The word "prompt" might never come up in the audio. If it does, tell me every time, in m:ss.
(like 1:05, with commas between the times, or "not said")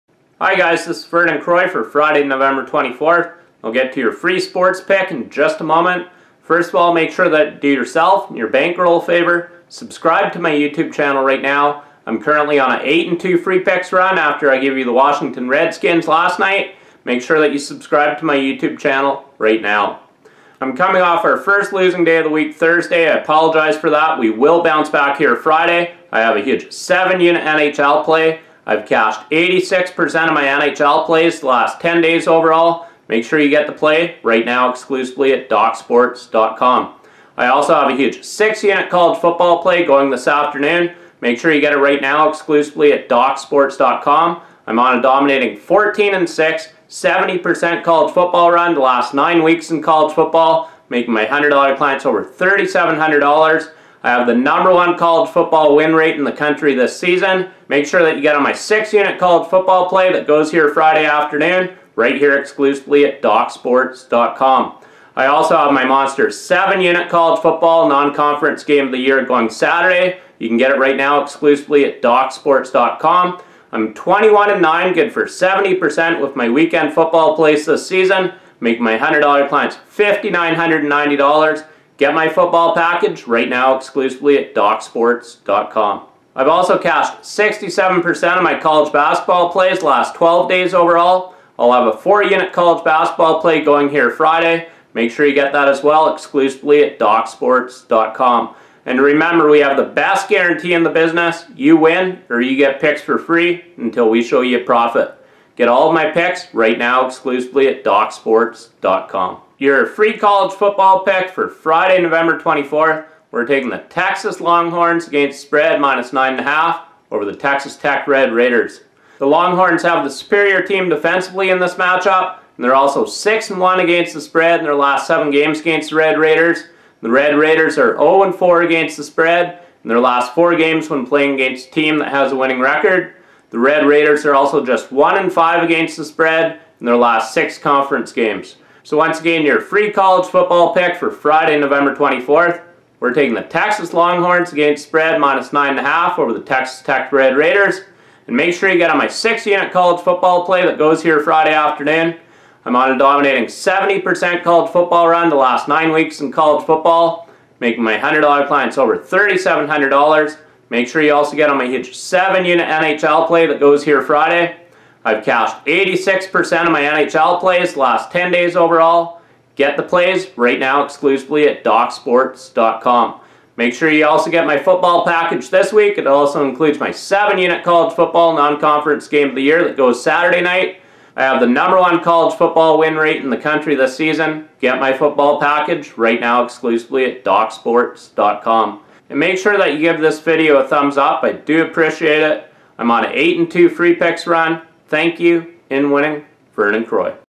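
not said.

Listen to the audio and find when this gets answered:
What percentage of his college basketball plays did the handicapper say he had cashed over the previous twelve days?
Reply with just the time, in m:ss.
1:27.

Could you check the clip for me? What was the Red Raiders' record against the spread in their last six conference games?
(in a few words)
1 and 5.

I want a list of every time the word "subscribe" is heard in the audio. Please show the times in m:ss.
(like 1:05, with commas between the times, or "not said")
0:09, 0:17.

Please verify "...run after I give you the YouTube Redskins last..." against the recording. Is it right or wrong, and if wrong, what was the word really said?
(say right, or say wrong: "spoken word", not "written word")
wrong: "Washington", not "YouTube".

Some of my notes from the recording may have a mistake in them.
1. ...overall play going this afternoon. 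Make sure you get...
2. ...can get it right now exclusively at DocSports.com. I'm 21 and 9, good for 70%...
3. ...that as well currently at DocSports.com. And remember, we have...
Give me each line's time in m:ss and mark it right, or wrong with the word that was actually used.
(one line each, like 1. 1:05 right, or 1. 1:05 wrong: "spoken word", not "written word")
1. 0:39 wrong: "football", not "overall"
2. 1:10 right
3. 1:35 wrong: "exclusively", not "currently".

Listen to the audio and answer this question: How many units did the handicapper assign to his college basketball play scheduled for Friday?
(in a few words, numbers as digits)
4.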